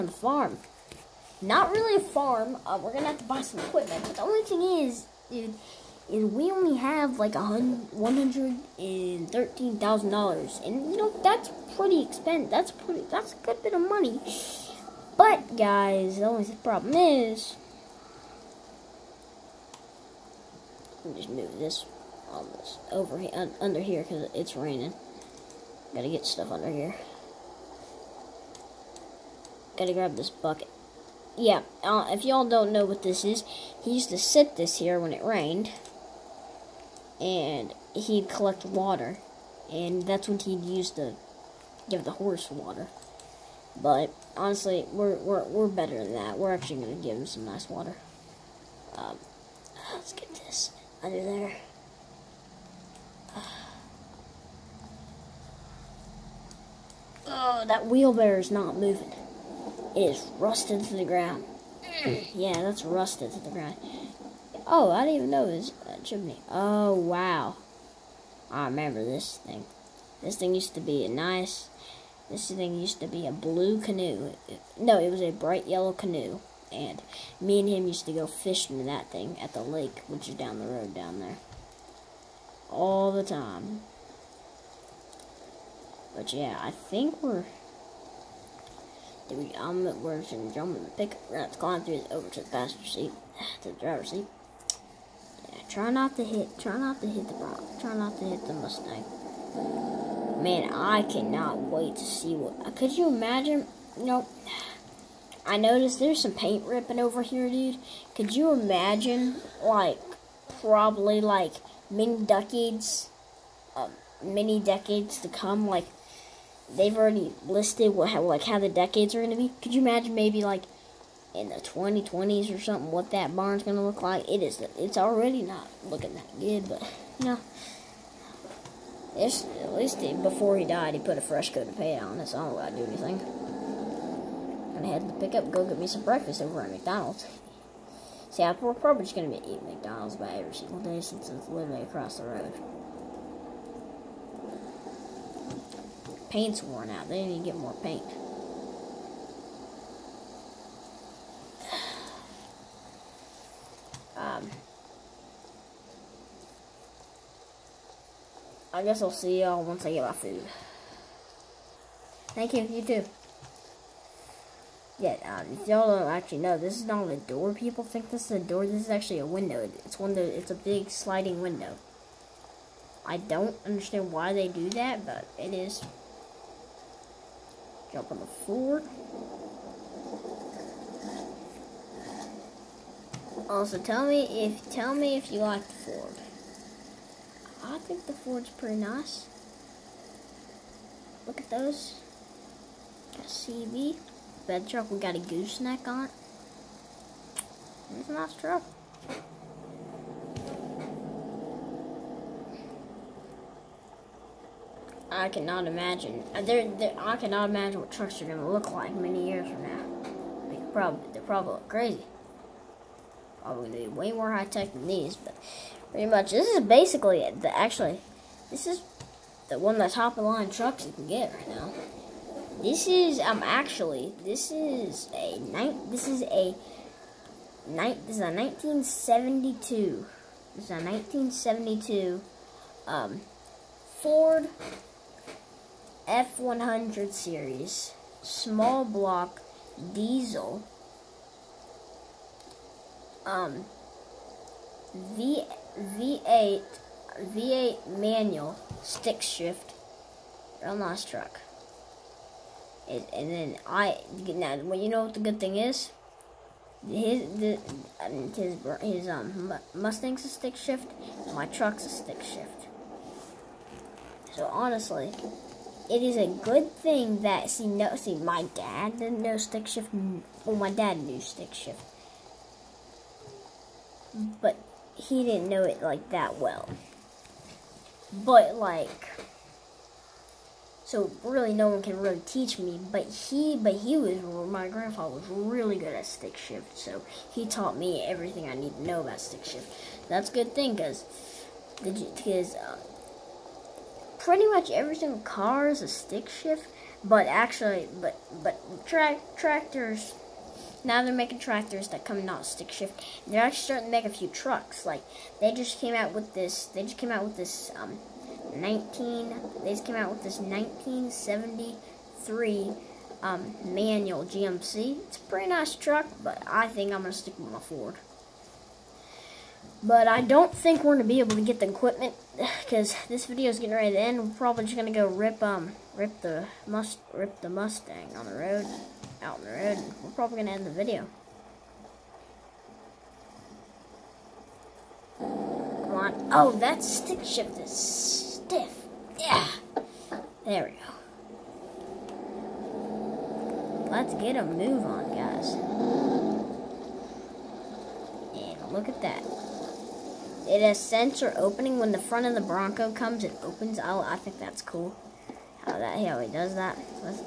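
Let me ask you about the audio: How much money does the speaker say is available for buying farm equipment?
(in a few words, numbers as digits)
$113,000.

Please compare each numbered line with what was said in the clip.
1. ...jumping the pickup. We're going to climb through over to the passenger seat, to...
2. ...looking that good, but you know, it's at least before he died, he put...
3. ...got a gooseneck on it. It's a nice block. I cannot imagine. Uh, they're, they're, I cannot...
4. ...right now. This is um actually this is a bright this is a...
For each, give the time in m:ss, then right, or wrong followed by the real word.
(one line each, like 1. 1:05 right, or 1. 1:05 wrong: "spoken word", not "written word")
1. 1:30 right
2. 2:05 right
3. 3:14 wrong: "truck", not "block"
4. 3:41 wrong: "night", not "bright".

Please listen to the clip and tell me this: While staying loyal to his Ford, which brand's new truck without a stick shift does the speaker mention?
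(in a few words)
GMC.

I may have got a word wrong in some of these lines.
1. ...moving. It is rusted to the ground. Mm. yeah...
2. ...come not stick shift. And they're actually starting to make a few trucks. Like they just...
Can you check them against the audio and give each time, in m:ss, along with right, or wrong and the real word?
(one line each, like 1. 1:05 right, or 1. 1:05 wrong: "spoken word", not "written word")
1. 0:58 right
2. 5:02 right.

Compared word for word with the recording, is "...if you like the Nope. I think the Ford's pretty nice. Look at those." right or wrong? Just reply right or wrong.
wrong.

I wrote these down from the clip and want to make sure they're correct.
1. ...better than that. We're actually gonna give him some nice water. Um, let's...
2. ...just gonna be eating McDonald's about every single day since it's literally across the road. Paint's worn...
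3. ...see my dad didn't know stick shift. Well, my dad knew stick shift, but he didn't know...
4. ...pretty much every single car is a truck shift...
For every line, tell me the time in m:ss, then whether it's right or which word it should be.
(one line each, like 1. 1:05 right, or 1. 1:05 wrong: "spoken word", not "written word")
1. 0:45 right
2. 2:19 right
3. 4:27 right
4. 4:54 wrong: "stick", not "truck".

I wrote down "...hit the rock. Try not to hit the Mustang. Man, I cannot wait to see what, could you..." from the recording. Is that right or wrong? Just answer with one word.
right.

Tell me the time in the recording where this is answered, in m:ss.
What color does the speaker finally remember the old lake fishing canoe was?
1:15.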